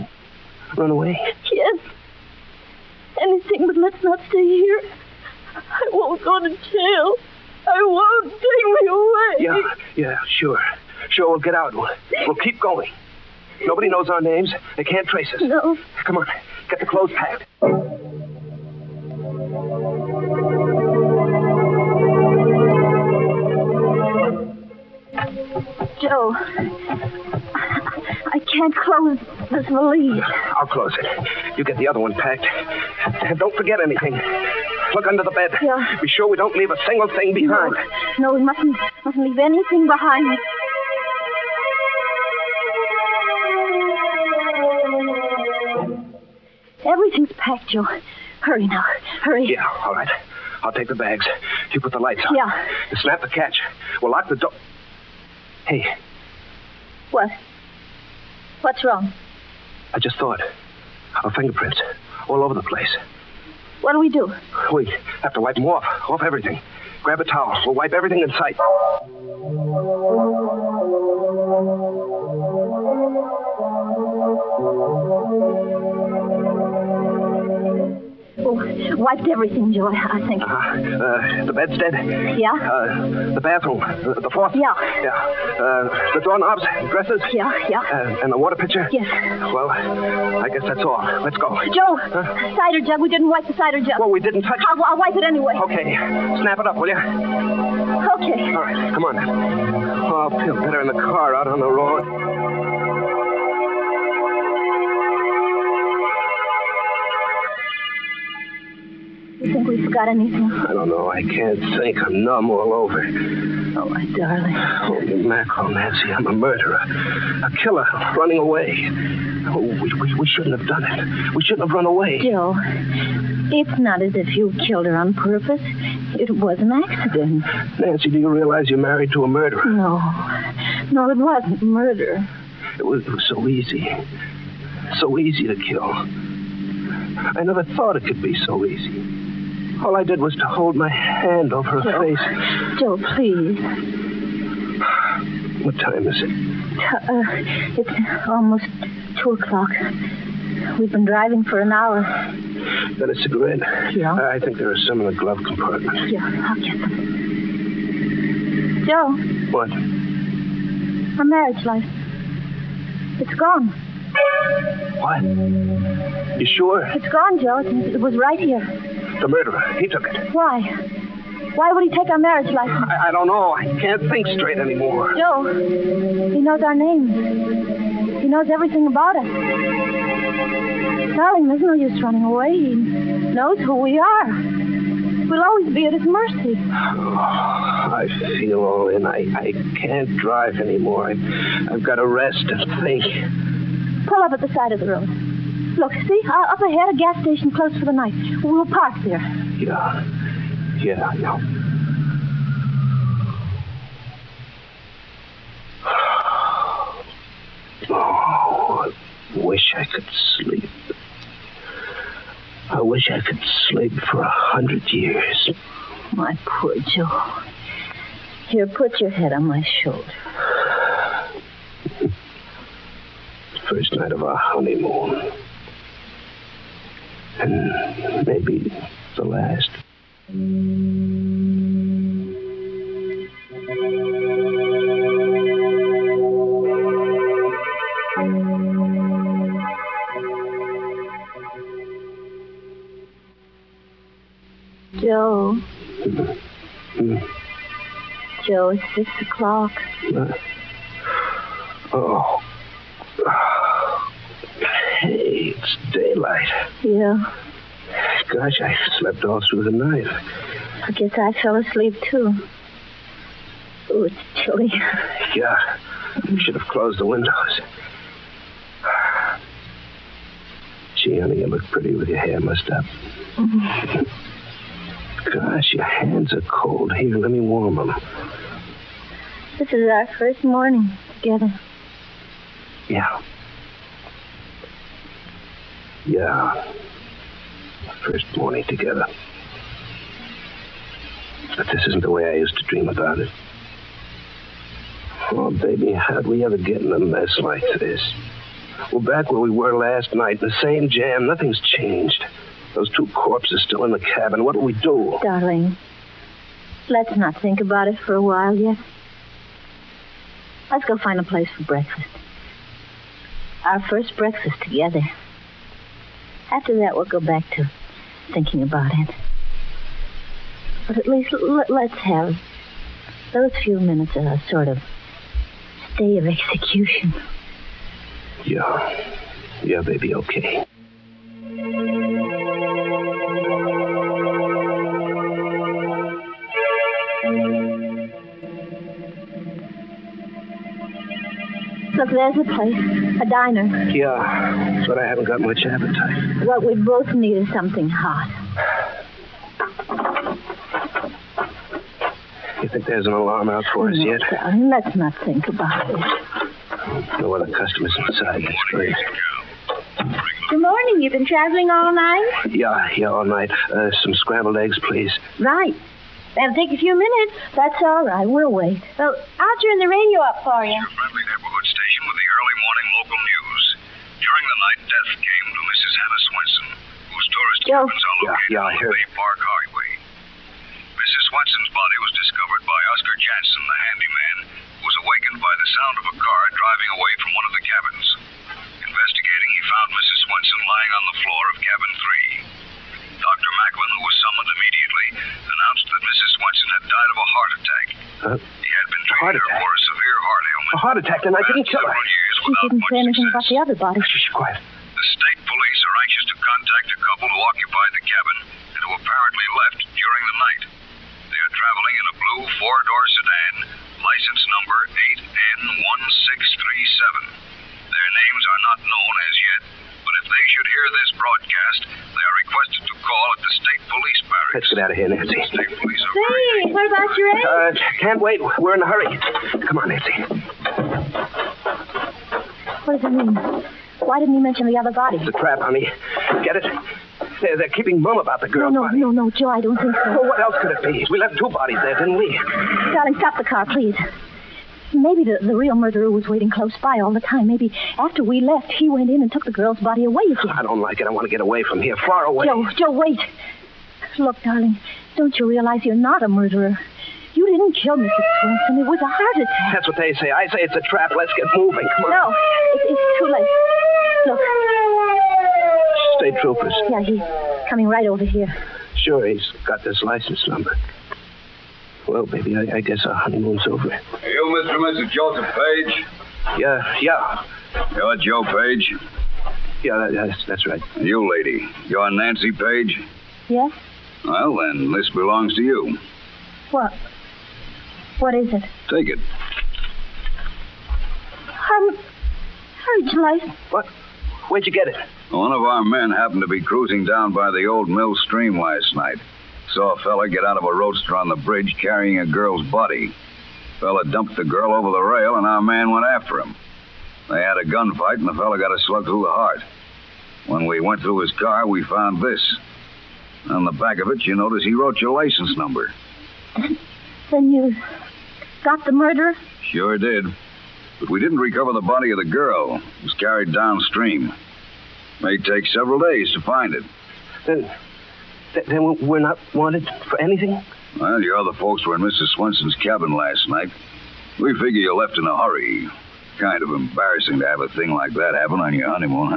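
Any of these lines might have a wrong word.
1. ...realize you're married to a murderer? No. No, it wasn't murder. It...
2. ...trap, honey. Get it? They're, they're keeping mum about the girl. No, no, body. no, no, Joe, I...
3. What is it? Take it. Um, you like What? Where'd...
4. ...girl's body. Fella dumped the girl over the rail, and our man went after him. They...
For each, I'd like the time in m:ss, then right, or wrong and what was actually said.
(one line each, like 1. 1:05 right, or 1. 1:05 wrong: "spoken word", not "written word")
1. 2:08 right
2. 7:15 right
3. 8:08 right
4. 8:22 right.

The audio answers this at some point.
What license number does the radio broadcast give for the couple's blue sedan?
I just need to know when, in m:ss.
6:55.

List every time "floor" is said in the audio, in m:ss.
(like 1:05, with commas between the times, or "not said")
1:24, 6:31.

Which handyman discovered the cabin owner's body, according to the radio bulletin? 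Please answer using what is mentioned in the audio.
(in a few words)
Oscar Jansen.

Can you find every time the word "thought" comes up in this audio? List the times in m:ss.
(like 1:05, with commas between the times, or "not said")
1:00, 2:17.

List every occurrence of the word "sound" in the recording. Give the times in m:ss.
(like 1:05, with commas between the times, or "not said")
6:25.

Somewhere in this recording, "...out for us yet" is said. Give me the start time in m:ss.
5:53.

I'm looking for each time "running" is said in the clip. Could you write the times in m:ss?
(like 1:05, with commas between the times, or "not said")
1:58, 3:02.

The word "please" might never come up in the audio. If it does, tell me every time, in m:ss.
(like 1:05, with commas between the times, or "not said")
2:23, 6:04, 7:23.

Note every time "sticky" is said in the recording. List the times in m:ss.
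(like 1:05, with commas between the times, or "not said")
not said.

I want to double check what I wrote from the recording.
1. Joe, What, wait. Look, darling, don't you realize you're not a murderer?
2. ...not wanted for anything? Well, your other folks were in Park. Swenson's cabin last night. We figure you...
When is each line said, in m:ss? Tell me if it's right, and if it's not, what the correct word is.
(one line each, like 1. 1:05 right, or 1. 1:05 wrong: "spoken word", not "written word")
1. 7:32 wrong: "Joe", not "What"
2. 8:49 wrong: "Mrs", not "Park".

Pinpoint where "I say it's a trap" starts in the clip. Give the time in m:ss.
7:40.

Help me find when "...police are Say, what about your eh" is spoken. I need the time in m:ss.
7:05.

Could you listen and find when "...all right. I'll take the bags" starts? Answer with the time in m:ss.
0:49.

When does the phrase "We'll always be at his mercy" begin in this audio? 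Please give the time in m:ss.
3:05.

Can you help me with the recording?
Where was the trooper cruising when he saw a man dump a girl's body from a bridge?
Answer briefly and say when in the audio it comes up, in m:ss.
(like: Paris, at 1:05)
old mill stream, at 8:17.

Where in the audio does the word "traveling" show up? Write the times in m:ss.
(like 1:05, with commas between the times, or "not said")
6:01, 6:51.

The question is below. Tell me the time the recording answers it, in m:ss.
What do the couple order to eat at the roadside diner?
6:04.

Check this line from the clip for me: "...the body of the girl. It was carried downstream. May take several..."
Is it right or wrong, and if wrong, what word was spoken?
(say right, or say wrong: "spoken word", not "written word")
right.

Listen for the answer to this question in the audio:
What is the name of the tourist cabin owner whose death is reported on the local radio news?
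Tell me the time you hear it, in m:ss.
6:15.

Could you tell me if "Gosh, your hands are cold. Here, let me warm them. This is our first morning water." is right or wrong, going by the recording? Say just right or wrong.
wrong.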